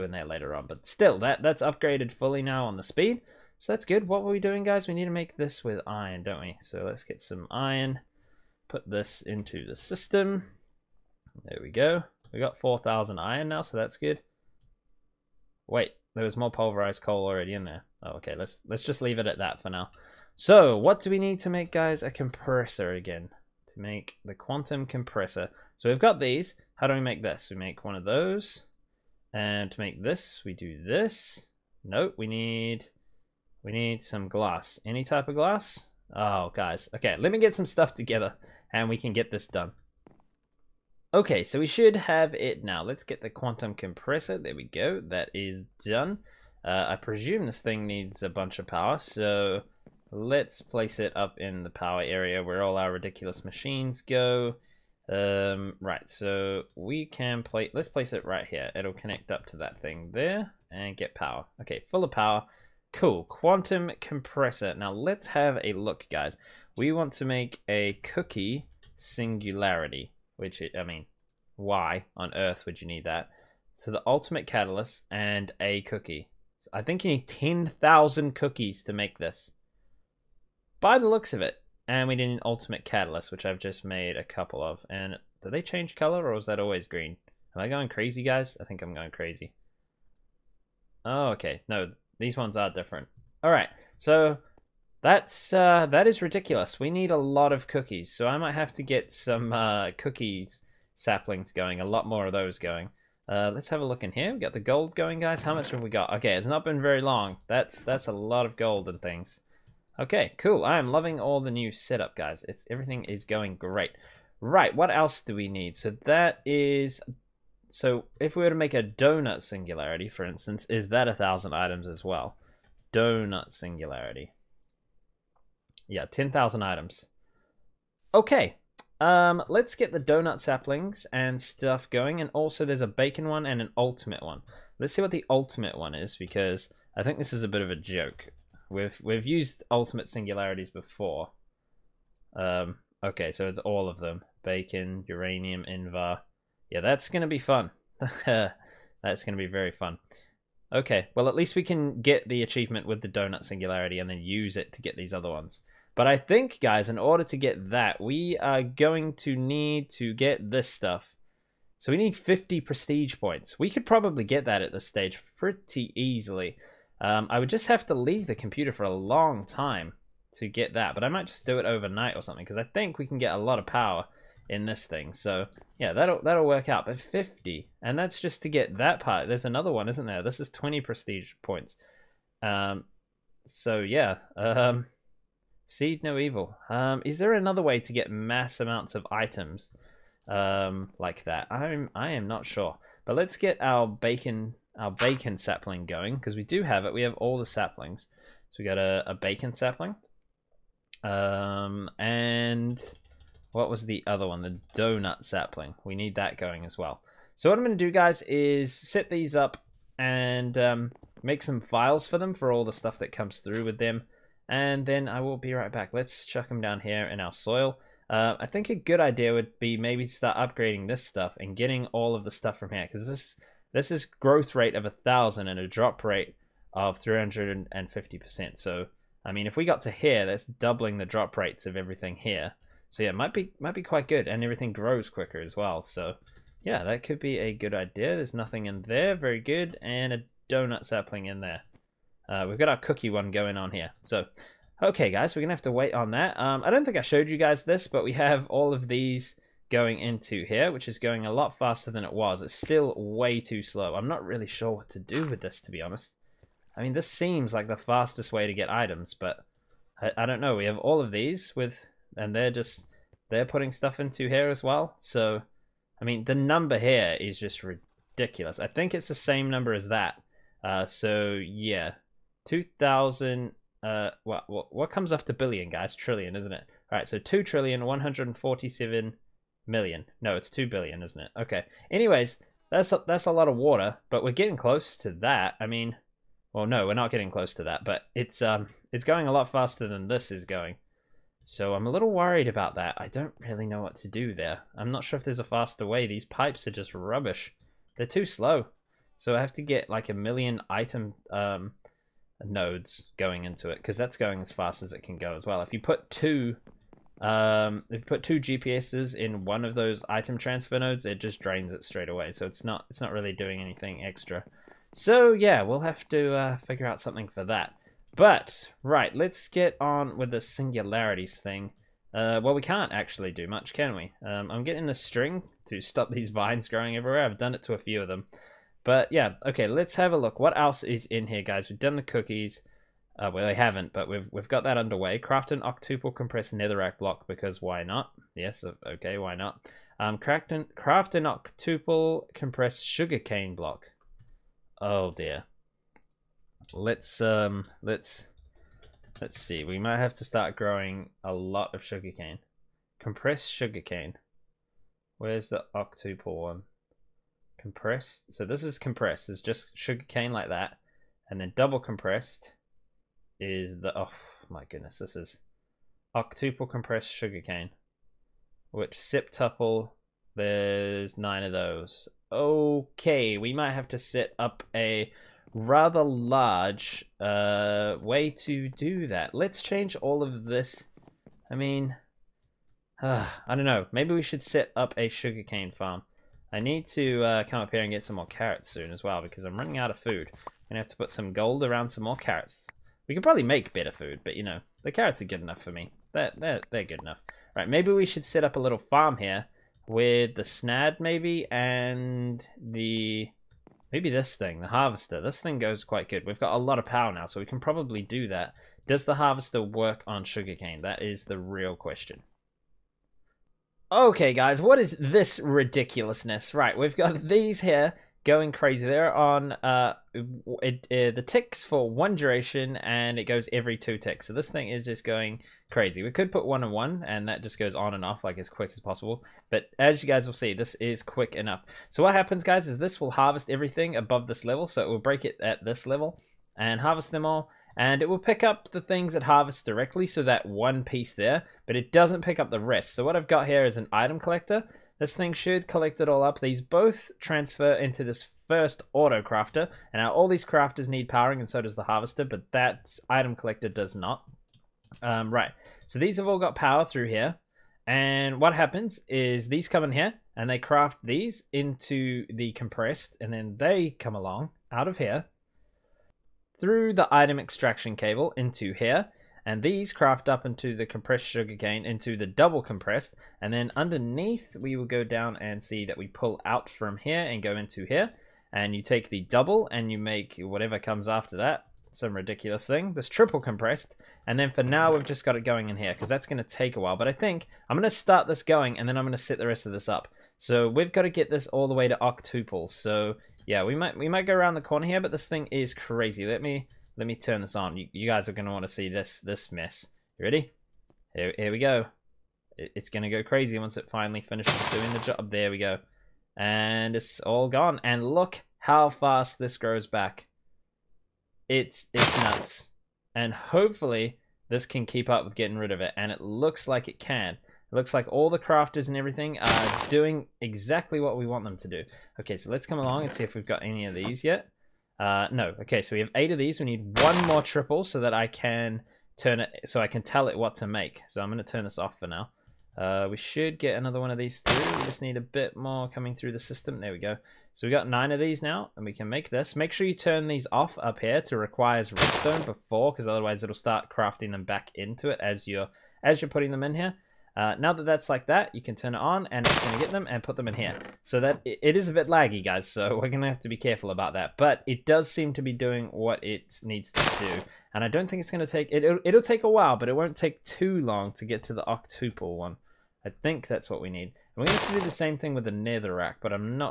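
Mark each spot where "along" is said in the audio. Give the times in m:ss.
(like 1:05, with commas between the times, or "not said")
7:44, 8:42.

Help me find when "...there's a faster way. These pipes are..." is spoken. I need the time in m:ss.
4:55.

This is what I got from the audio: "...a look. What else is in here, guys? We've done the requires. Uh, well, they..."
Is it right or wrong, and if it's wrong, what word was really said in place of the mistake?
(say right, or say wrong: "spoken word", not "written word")
wrong: "cookies", not "requires".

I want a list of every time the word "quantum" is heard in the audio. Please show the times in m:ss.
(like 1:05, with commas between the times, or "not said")
0:24, 0:43, 1:03.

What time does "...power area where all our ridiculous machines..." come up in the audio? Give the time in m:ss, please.
0:51.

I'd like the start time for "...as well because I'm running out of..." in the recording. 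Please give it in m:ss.
6:28.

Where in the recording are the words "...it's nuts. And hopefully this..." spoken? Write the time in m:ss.
8:31.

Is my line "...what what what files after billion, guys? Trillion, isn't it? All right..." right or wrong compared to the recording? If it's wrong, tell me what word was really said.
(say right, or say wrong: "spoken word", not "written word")
wrong: "comes", not "files".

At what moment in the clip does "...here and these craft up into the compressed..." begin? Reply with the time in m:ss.
7:48.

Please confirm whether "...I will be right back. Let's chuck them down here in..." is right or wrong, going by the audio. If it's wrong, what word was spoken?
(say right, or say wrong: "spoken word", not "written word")
right.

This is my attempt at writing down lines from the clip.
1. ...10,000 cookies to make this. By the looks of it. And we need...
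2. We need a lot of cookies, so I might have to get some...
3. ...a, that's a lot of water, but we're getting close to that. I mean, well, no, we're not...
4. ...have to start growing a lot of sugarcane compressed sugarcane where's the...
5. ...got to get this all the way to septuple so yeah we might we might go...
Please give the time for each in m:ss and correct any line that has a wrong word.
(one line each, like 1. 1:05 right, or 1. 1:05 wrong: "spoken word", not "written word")
1. 1:17 right
2. 1:36 right
3. 4:42 right
4. 5:49 right
5. 8:10 wrong: "octuple", not "septuple".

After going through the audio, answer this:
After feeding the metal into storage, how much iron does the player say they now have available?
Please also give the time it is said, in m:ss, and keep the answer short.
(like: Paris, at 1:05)
4,000, at 0:12.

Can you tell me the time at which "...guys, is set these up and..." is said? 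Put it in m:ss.
3:27.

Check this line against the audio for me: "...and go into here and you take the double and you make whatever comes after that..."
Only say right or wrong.
right.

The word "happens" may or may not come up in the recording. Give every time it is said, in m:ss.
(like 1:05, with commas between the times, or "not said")
7:12, 7:38.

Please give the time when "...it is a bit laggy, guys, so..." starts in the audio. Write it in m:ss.
9:11.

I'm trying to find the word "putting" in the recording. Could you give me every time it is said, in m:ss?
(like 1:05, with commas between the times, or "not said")
4:23, 9:06.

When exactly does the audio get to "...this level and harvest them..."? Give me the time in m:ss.
7:15.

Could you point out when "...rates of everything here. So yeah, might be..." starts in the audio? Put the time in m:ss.
3:51.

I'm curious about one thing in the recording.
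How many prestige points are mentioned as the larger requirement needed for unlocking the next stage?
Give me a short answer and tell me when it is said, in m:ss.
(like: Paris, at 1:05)
50, at 2:42.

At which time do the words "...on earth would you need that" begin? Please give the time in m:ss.
1:12.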